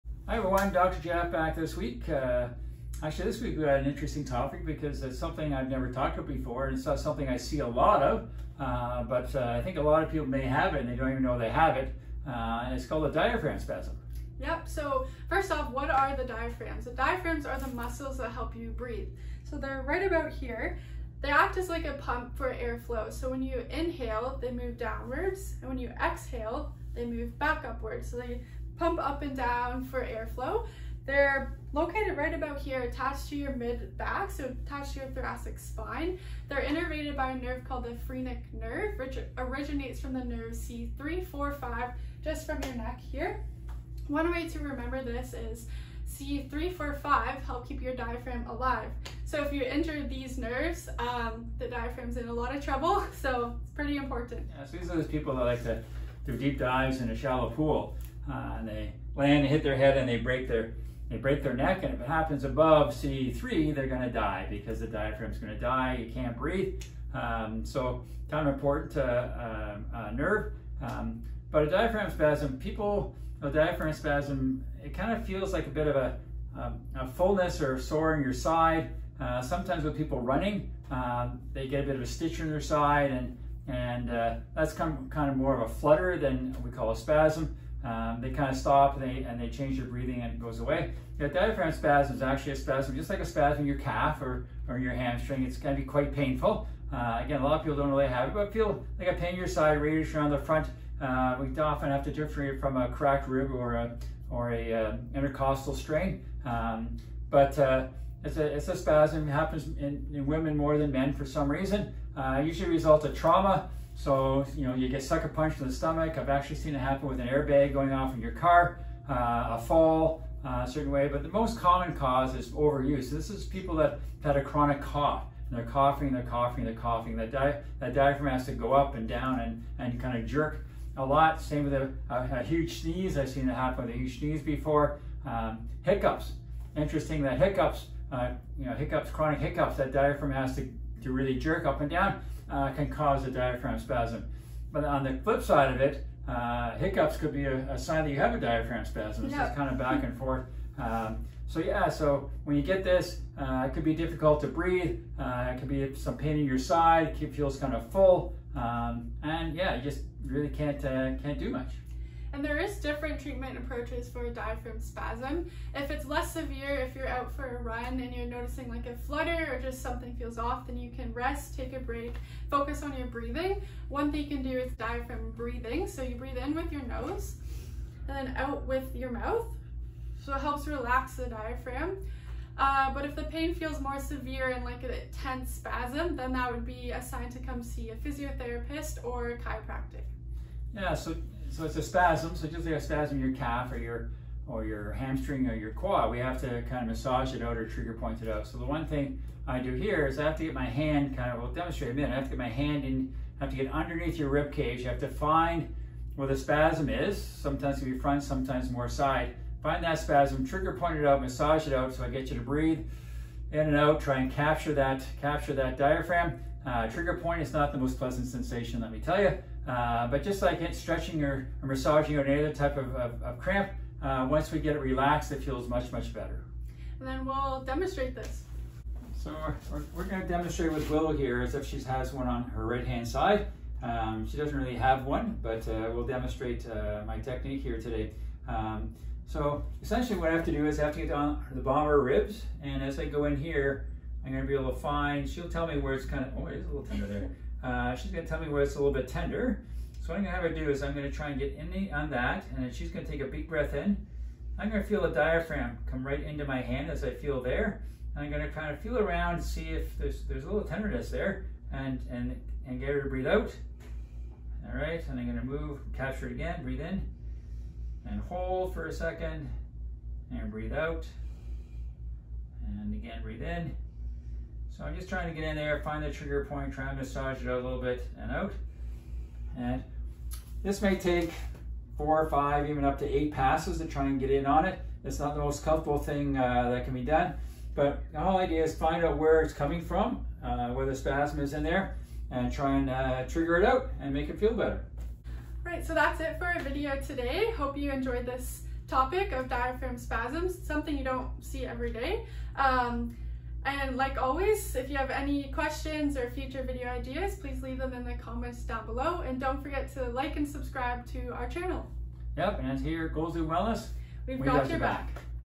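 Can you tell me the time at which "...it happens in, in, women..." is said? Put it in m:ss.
1:49.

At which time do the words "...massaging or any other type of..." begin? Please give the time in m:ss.
3:41.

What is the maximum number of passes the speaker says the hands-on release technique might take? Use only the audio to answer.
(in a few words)
8.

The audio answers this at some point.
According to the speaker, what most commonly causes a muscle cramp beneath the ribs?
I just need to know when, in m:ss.
2:02.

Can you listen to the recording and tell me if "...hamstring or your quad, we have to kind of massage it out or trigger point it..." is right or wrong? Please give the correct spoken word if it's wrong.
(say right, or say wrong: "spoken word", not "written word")
right.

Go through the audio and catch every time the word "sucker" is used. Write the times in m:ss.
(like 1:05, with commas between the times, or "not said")
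1:55.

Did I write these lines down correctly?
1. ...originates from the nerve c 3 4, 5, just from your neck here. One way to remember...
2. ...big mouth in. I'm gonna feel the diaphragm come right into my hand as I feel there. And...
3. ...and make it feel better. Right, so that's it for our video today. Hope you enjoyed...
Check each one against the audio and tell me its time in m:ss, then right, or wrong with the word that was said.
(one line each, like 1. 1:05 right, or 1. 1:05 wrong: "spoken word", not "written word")
1. 0:39 right
2. 4:13 wrong: "breath", not "mouth"
3. 4:54 right.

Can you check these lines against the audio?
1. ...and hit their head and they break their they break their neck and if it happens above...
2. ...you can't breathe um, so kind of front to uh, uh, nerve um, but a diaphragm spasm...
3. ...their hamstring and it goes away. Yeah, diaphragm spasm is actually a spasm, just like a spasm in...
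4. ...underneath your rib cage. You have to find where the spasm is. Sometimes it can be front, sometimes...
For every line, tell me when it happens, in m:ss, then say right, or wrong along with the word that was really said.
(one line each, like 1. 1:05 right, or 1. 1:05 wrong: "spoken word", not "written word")
1. 0:59 right
2. 1:06 wrong: "important", not "front"
3. 1:29 wrong: "breathing", not "hamstring"
4. 3:23 right.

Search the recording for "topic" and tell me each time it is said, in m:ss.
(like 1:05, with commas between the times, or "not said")
0:04, 4:58.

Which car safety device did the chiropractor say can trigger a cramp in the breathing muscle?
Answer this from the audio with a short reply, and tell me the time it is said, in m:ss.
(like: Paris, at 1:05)
airbag, at 1:57.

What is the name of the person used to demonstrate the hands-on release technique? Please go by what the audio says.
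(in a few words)
Willow.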